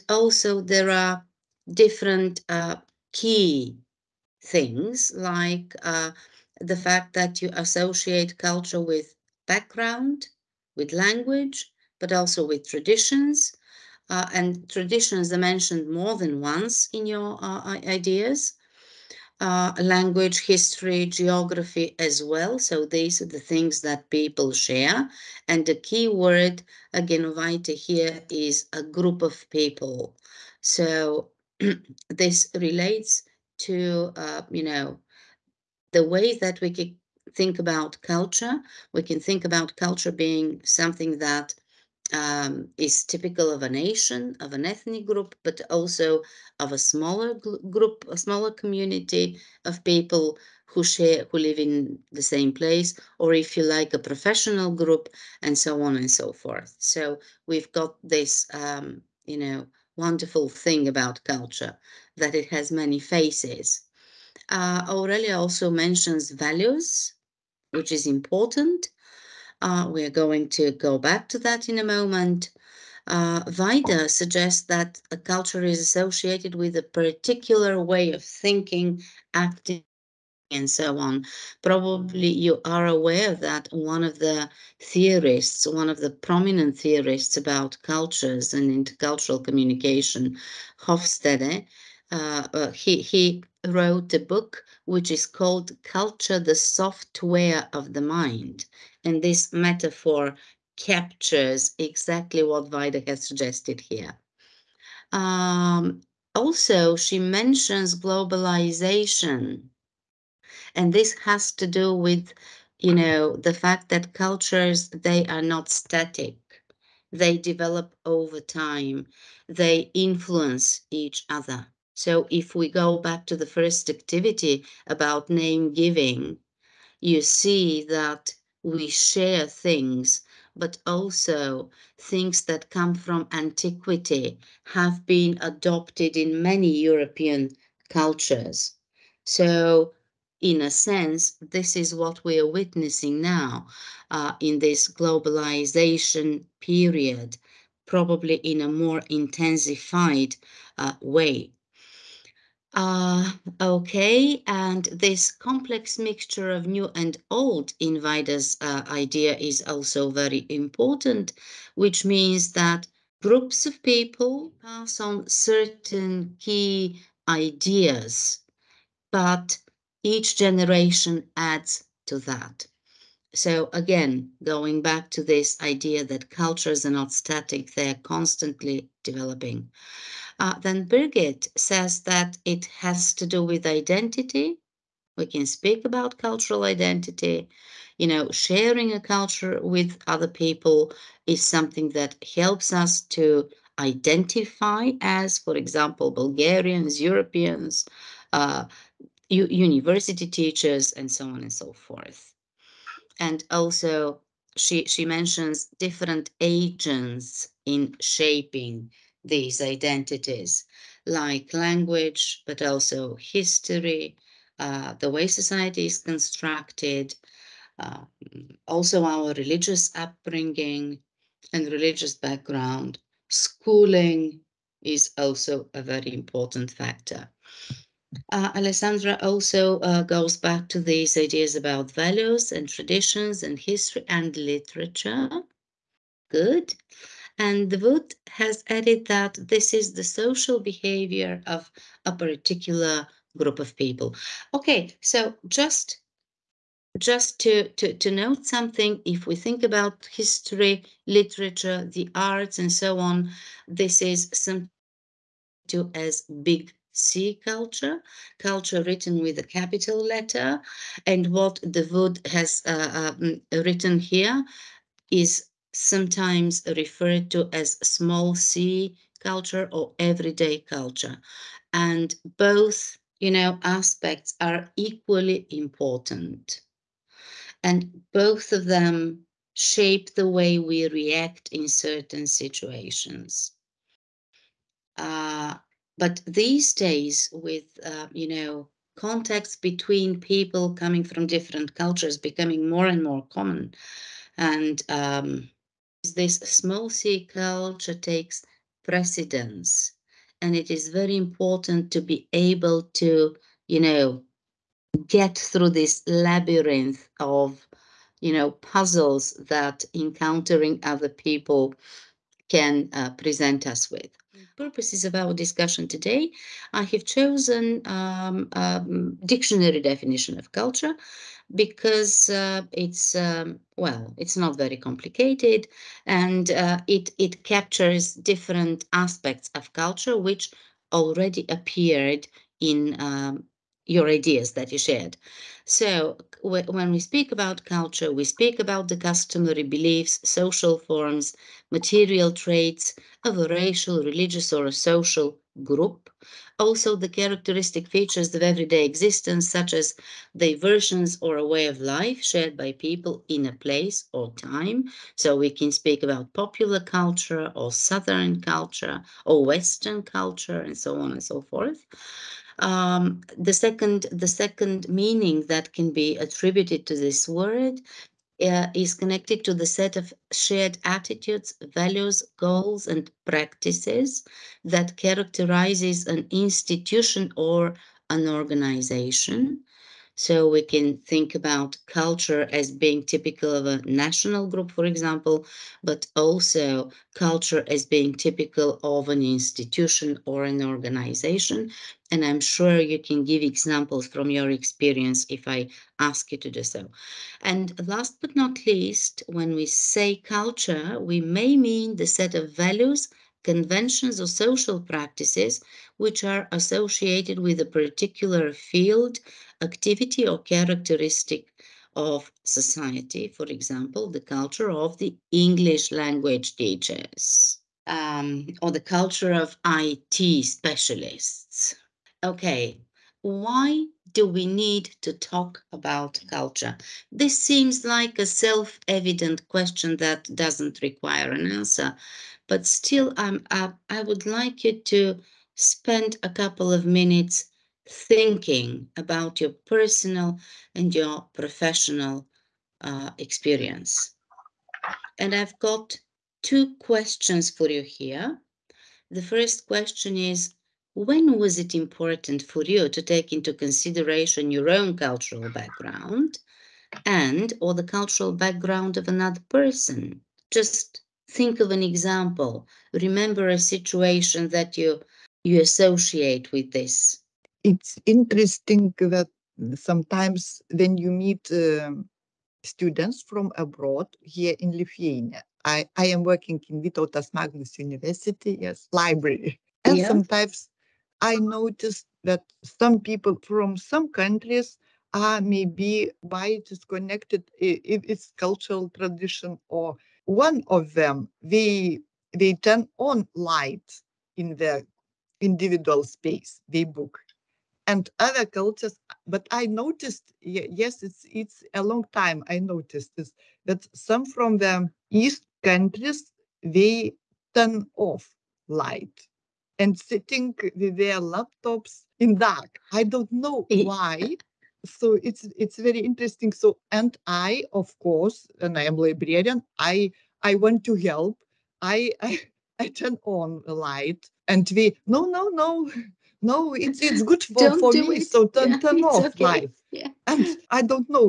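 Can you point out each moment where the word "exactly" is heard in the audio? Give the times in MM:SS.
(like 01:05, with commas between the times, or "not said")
01:41.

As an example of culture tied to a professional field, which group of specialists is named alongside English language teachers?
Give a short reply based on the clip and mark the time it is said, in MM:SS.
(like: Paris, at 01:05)
IT specialists, at 06:59.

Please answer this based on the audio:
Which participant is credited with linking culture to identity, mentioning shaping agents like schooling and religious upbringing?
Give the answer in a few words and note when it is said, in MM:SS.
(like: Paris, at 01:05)
Birgit, at 03:00.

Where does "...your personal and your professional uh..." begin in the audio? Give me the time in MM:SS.
07:19.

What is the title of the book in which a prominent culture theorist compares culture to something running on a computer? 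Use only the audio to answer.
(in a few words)
Culture, the Software of the Mind.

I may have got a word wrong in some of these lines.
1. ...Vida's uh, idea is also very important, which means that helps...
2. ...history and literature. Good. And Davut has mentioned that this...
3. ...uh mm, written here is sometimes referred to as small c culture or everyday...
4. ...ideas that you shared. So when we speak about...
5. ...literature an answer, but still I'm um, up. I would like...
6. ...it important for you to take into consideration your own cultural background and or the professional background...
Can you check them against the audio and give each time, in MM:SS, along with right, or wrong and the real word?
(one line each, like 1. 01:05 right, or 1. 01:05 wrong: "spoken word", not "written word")
1. 02:37 wrong: "groups", not "helps"
2. 03:53 wrong: "added", not "mentioned"
3. 04:22 right
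4. 05:34 right
5. 07:10 wrong: "require", not "literature"
6. 07:31 wrong: "cultural", not "professional".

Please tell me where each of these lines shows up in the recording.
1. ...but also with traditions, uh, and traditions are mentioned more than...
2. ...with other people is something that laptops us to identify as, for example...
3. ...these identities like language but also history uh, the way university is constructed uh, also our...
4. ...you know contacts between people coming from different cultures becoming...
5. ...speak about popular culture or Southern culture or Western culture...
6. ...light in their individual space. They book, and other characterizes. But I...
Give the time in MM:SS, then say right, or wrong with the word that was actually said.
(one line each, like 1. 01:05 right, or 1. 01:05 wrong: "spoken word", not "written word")
1. 00:11 right
2. 03:09 wrong: "helps", not "laptops"
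3. 03:29 wrong: "society", not "university"
4. 04:48 right
5. 05:55 right
6. 08:13 wrong: "cultures", not "characterizes".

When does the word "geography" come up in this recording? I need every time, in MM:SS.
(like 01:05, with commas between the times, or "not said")
00:21.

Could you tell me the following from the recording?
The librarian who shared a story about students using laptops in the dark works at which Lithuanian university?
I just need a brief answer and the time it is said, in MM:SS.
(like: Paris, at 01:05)
Vytautas Magnus University, at 07:56.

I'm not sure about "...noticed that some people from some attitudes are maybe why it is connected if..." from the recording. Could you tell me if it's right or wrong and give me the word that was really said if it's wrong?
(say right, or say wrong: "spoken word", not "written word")
wrong: "countries", not "attitudes".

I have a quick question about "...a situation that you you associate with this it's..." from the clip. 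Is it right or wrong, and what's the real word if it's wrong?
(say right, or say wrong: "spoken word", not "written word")
right.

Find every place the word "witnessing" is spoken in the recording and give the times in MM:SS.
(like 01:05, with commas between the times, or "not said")
02:22.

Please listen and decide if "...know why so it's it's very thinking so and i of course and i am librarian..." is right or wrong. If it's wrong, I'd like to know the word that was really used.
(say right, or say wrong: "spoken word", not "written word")
wrong: "interesting", not "thinking".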